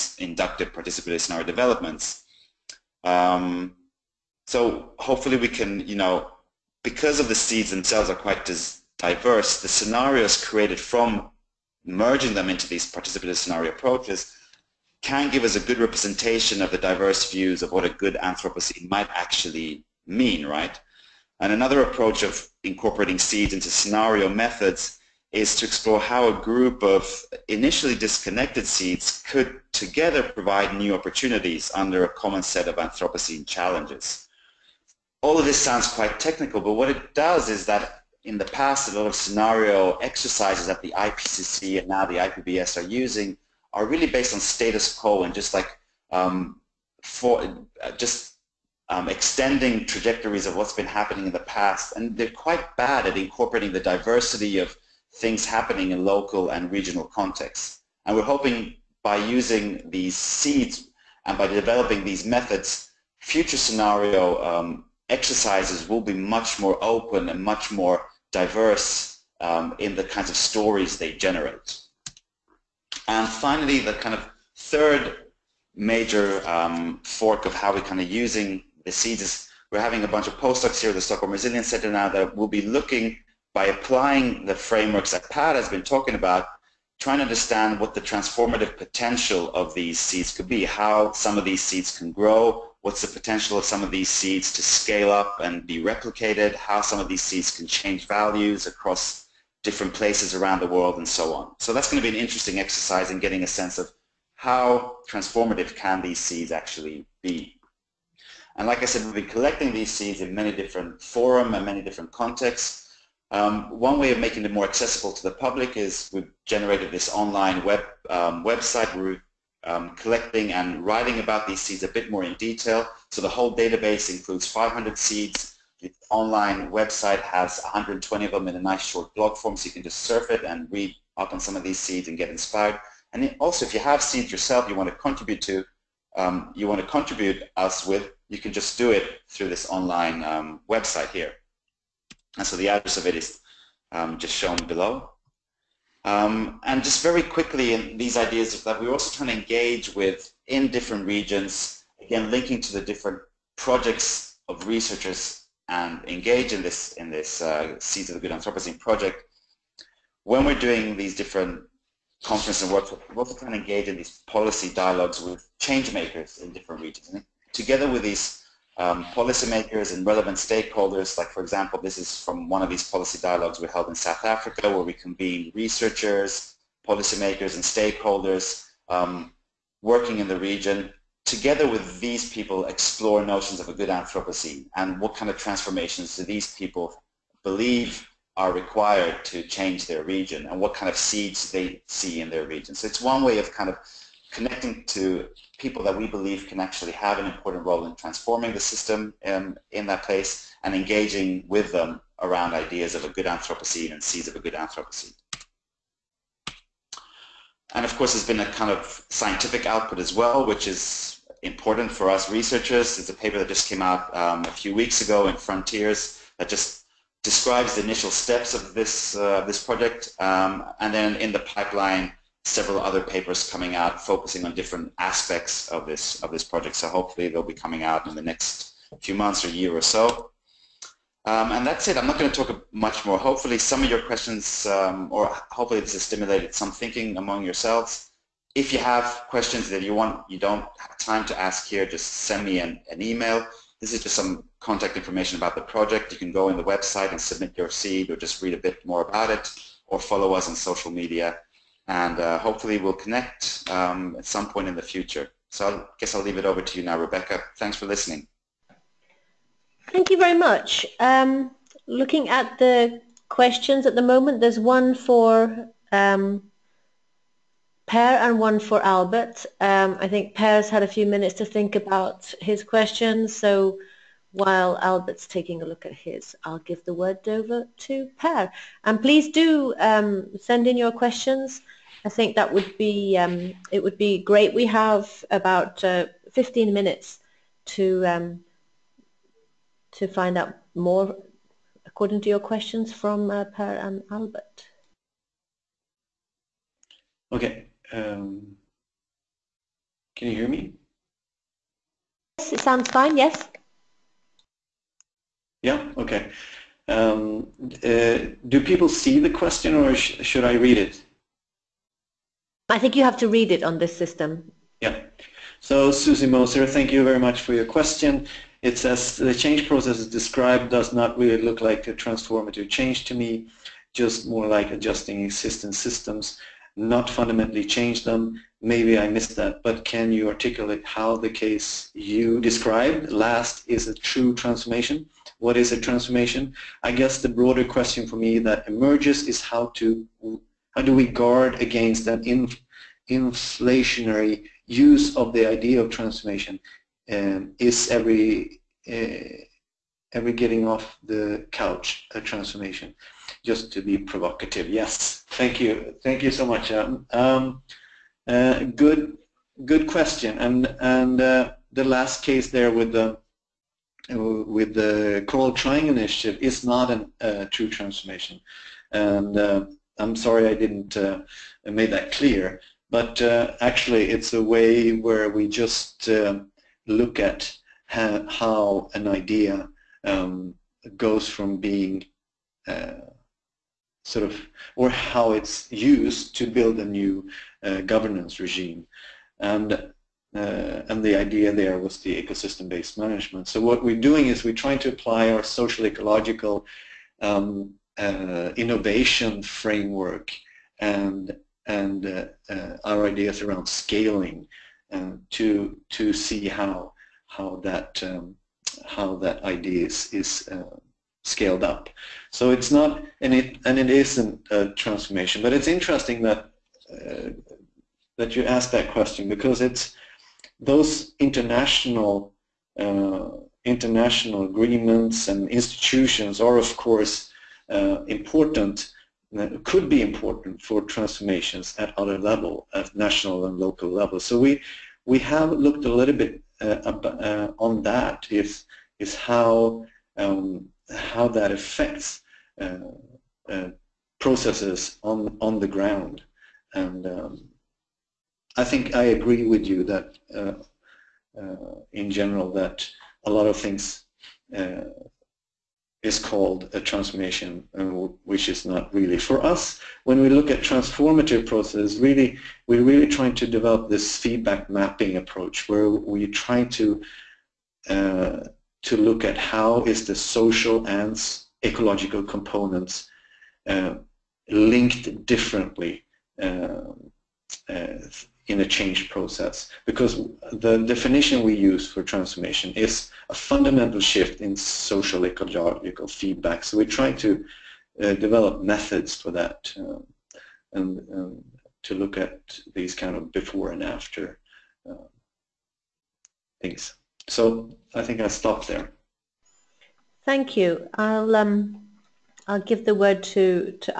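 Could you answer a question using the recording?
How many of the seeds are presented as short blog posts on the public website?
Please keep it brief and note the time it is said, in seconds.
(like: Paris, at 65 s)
120, at 127 s.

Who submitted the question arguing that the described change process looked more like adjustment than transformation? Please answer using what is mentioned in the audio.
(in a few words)
Susie Moser.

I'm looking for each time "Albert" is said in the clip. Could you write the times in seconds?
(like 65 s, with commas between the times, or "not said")
268 s, 274 s, 294 s.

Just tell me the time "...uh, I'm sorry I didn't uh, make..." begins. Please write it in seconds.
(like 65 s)
369 s.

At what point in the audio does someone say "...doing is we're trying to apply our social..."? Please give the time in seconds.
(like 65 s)
393 s.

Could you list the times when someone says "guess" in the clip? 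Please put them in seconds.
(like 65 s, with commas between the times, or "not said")
255 s, 336 s.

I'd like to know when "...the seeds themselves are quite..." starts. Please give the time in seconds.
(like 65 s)
7 s.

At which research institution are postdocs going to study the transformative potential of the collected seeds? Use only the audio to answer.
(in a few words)
Stockholm Resilience Center.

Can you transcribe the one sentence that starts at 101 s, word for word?
So that's going to be an interesting exercise in getting a sense of how transformative can these seeds actually be.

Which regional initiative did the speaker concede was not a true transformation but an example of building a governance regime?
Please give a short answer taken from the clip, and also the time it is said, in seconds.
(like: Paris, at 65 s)
Coral Triangle Initiative, at 365 s.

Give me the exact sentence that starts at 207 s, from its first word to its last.
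And of course, there's been a kind of scientific output as well, which is important for us researchers.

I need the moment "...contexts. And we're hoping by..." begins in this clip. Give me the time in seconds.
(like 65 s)
57 s.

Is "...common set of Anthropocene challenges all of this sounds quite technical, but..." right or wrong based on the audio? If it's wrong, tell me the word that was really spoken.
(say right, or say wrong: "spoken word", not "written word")
right.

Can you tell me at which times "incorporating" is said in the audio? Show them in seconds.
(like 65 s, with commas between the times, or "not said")
22 s, 53 s.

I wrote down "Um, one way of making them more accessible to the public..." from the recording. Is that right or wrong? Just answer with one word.
right.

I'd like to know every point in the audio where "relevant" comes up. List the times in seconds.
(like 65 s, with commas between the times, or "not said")
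170 s.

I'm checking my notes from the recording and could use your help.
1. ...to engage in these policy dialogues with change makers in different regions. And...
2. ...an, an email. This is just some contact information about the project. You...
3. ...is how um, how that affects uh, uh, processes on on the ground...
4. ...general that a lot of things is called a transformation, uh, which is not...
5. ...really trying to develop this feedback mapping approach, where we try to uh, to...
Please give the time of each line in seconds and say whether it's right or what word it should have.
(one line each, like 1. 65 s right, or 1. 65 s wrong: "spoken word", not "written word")
1. 163 s right
2. 242 s right
3. 438 s right
4. 452 s right
5. 462 s right.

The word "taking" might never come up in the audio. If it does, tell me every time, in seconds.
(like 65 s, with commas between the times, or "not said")
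275 s.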